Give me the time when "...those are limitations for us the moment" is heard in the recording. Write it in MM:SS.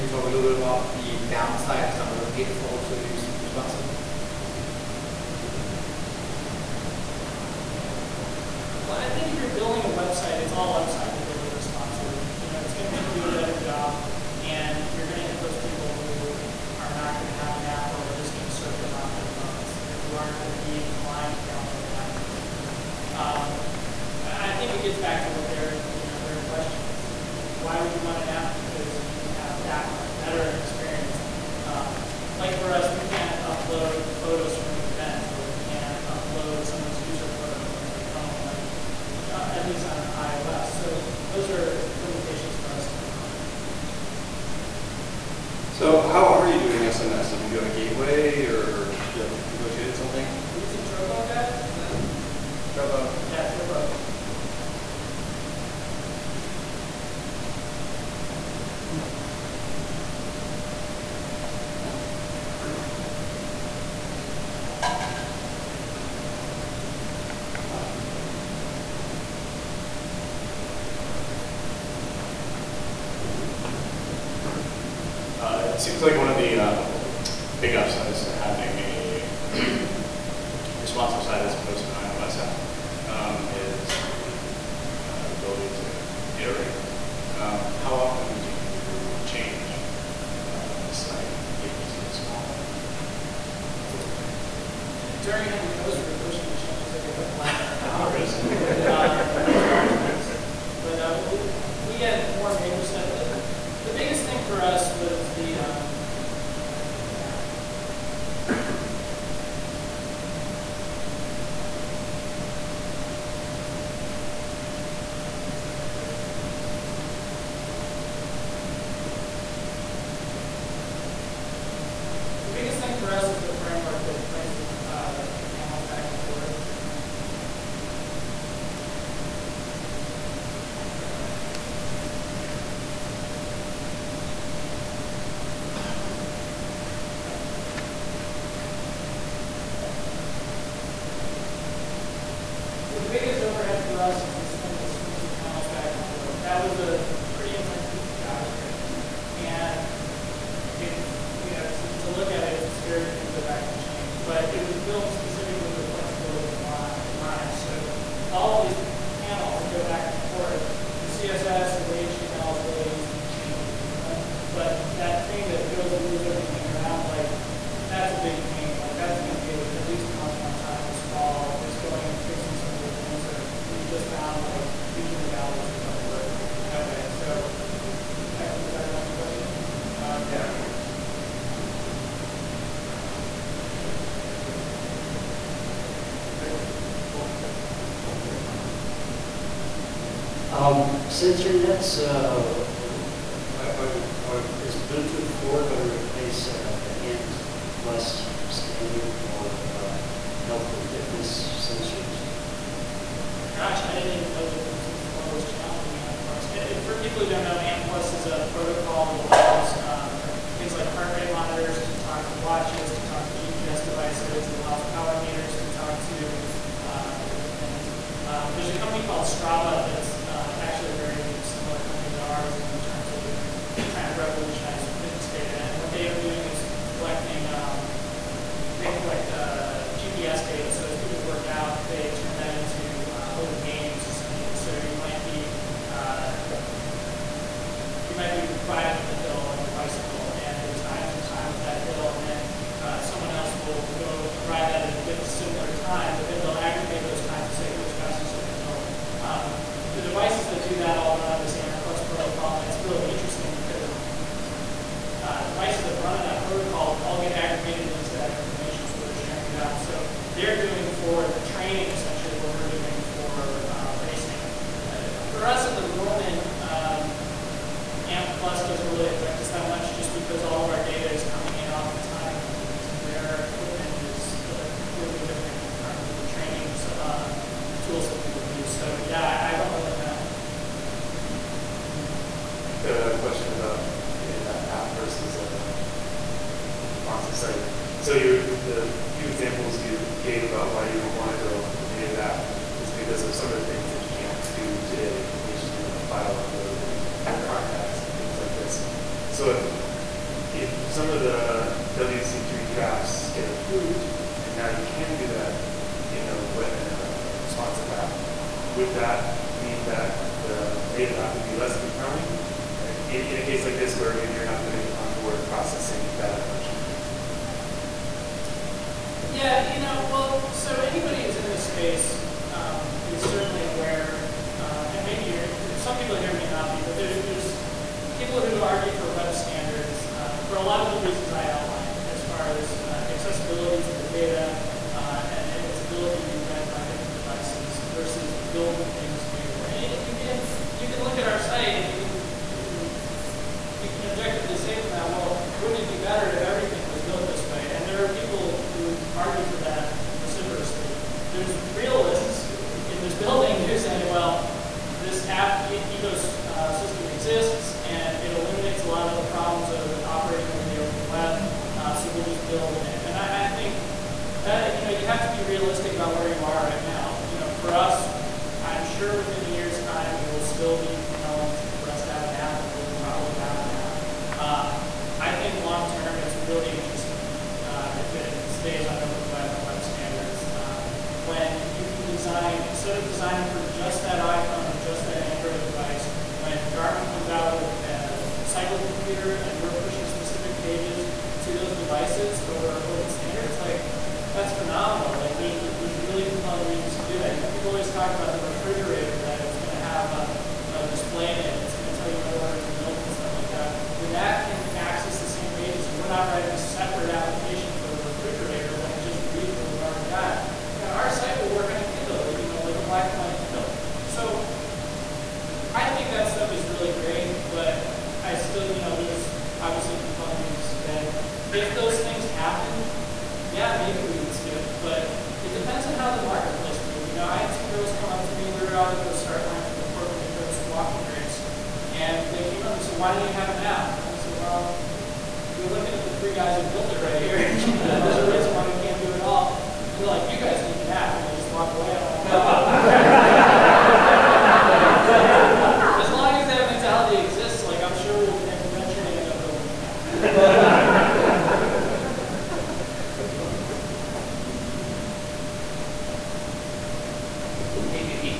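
00:41.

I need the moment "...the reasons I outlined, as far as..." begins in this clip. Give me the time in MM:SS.
05:31.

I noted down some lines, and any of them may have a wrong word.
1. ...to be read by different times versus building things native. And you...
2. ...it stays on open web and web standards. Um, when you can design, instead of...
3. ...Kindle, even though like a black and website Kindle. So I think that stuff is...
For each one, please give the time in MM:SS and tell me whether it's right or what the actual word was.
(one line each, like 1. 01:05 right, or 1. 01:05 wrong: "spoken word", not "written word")
1. 05:36 wrong: "devices", not "times"
2. 06:18 right
3. 06:51 wrong: "white", not "website".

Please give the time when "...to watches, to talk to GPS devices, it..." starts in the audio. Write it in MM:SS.
03:32.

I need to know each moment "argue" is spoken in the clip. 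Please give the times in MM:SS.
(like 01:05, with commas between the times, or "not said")
05:28, 05:49.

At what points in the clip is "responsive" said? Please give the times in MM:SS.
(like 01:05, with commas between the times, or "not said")
00:03, 00:11, 04:47, 05:07.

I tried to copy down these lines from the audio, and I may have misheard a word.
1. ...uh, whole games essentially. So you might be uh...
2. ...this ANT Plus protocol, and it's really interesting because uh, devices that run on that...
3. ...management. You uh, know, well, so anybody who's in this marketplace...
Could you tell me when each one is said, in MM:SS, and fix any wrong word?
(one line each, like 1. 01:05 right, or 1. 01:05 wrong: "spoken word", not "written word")
1. 03:53 right
2. 04:11 right
3. 05:16 wrong: "space", not "marketplace".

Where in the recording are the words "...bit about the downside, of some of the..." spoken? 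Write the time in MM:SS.
00:00.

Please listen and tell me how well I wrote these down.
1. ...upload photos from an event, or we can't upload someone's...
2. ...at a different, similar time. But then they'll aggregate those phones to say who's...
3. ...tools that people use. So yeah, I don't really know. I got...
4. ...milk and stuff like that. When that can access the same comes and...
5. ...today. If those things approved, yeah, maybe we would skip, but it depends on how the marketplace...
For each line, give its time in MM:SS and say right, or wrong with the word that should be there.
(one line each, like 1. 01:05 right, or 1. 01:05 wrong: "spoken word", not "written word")
1. 00:33 right
2. 04:04 wrong: "times", not "phones"
3. 04:37 right
4. 06:42 wrong: "pages", not "comes"
5. 07:00 wrong: "happened", not "approved".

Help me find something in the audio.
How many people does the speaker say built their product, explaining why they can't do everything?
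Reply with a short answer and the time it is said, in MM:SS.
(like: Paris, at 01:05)
3, at 07:16.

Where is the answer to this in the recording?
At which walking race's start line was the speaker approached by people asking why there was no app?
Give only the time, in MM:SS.
07:09.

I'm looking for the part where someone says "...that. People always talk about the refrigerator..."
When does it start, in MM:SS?
06:37.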